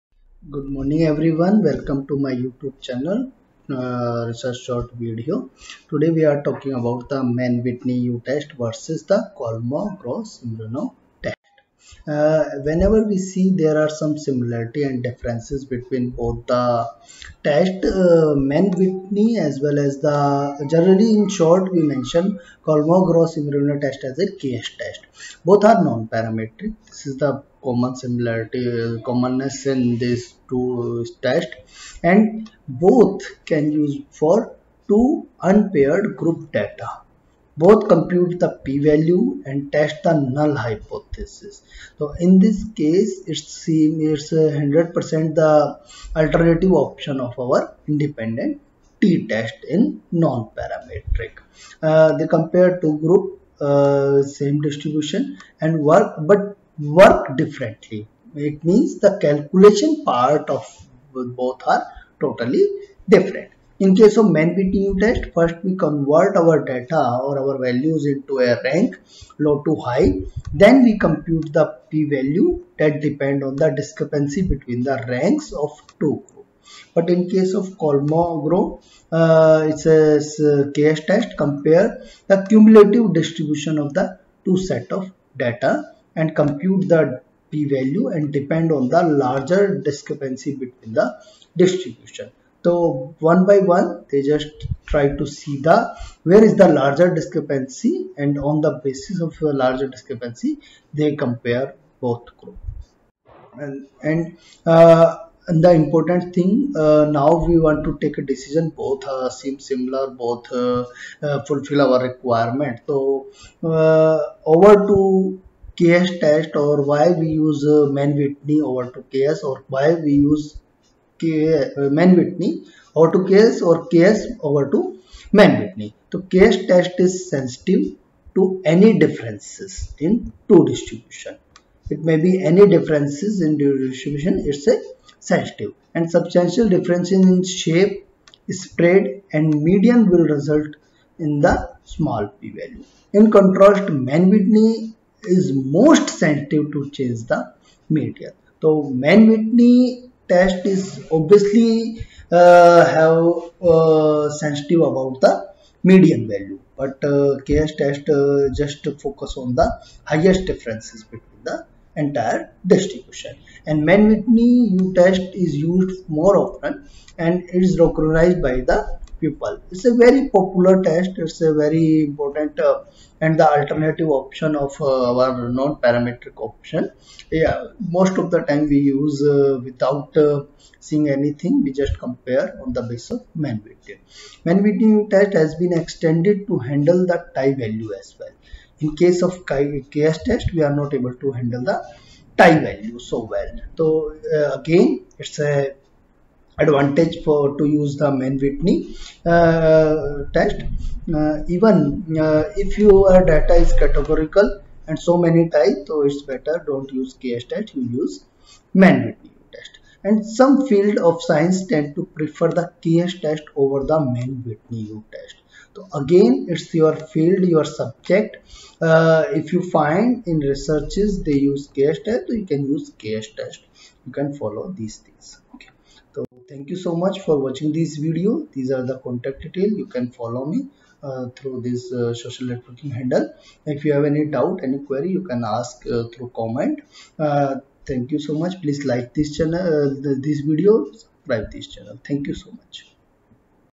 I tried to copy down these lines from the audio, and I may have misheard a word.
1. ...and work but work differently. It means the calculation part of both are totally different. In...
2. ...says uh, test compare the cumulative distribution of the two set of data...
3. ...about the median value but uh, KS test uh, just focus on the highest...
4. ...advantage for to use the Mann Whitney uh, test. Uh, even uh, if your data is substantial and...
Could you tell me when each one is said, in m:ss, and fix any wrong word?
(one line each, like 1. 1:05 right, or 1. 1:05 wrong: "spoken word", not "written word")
1. 0:55 right
2. 1:19 right
3. 2:34 right
4. 3:16 wrong: "categorical", not "substantial".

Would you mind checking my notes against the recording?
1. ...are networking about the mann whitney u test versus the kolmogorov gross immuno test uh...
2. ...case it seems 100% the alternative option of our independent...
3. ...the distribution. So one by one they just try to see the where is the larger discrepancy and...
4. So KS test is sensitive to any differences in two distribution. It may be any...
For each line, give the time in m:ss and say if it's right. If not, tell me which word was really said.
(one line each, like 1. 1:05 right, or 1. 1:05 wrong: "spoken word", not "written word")
1. 0:06 wrong: "talking", not "networking"
2. 0:42 right
3. 1:30 right
4. 2:06 right.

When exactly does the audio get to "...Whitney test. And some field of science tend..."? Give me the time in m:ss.
3:29.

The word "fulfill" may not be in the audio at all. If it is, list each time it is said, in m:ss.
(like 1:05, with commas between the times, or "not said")
1:51.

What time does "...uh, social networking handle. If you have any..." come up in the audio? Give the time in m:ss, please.
3:51.